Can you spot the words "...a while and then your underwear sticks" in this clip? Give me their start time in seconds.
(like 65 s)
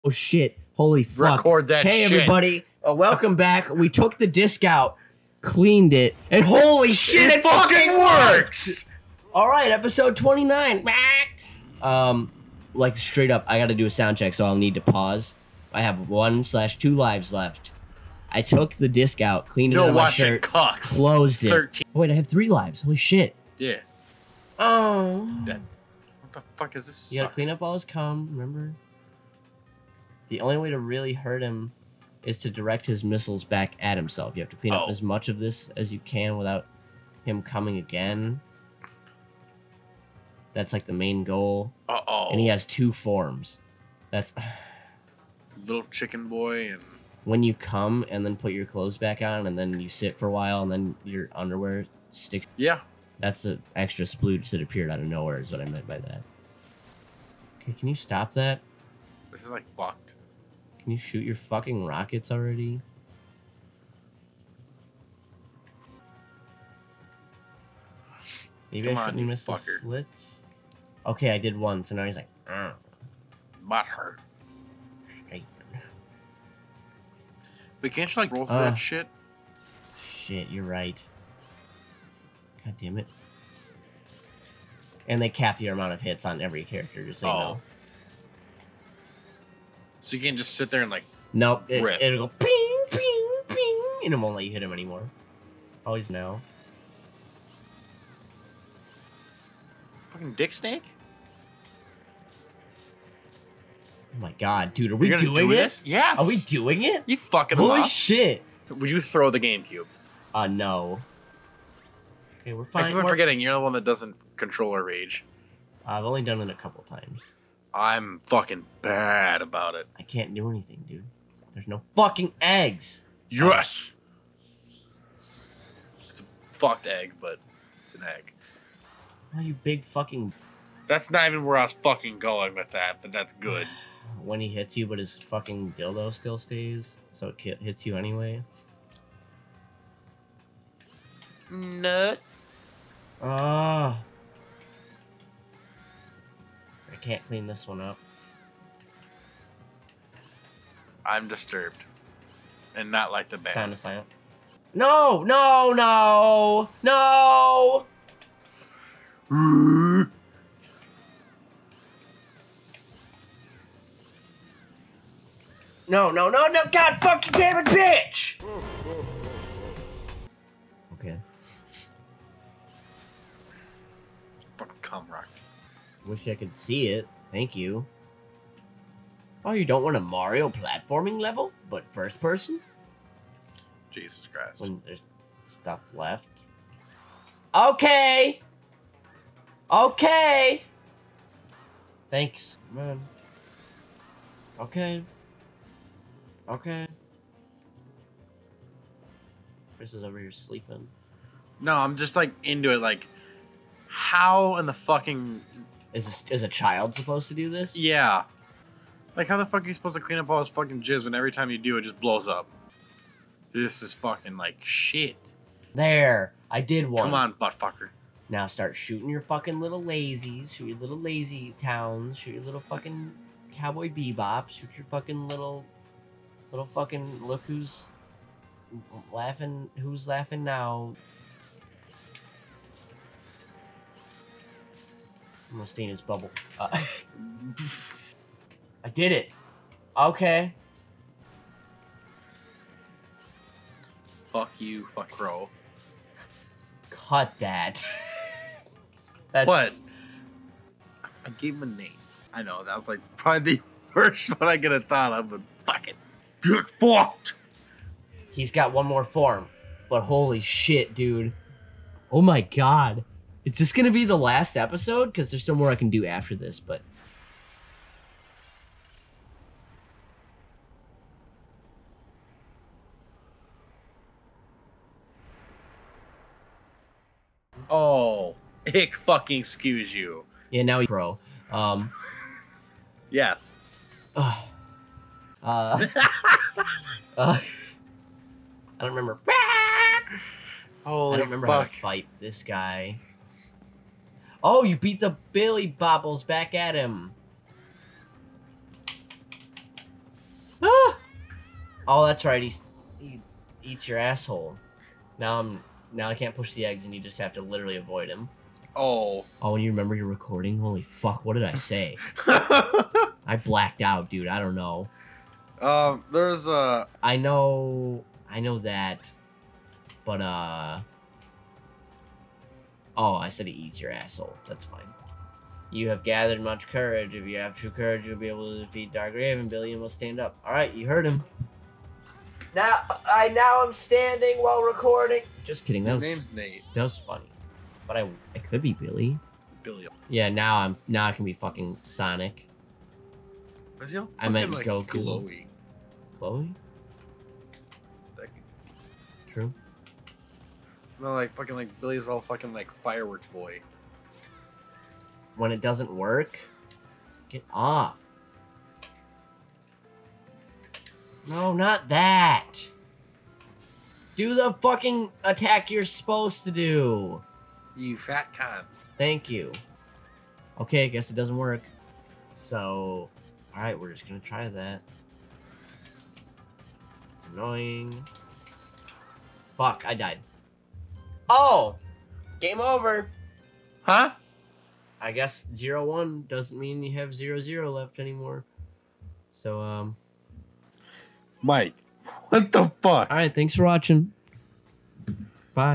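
50 s.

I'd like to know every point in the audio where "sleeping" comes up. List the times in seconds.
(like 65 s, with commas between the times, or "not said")
200 s.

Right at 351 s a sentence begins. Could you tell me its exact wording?
No, like fucking like Billy's all fucking like fireworks boy.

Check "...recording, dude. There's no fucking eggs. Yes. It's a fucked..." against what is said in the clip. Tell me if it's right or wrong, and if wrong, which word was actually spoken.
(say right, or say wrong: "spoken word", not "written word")
wrong: "anything", not "recording".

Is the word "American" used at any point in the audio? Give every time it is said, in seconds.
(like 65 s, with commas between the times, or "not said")
not said.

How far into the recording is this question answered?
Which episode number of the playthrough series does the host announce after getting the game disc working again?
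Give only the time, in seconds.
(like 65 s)
9 s.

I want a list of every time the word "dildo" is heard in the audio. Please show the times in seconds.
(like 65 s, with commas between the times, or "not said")
135 s.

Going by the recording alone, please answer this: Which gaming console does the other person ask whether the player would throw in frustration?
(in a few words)
GameCube.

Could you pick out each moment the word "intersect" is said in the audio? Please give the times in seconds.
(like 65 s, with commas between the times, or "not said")
not said.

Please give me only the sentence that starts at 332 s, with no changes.
Now I now i am standing while recording.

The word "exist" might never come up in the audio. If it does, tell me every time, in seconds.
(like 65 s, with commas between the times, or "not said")
not said.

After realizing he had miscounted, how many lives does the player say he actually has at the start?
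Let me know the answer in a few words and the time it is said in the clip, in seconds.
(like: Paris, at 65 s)
3, at 22 s.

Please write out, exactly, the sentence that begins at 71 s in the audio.
Okay, I did one, so now he's like, Argh.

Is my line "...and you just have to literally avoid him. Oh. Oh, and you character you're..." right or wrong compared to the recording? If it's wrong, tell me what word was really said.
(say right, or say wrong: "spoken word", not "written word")
wrong: "remember", not "character".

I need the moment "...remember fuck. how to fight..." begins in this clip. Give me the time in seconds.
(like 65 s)
291 s.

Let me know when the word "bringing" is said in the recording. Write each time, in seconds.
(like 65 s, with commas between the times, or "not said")
not said.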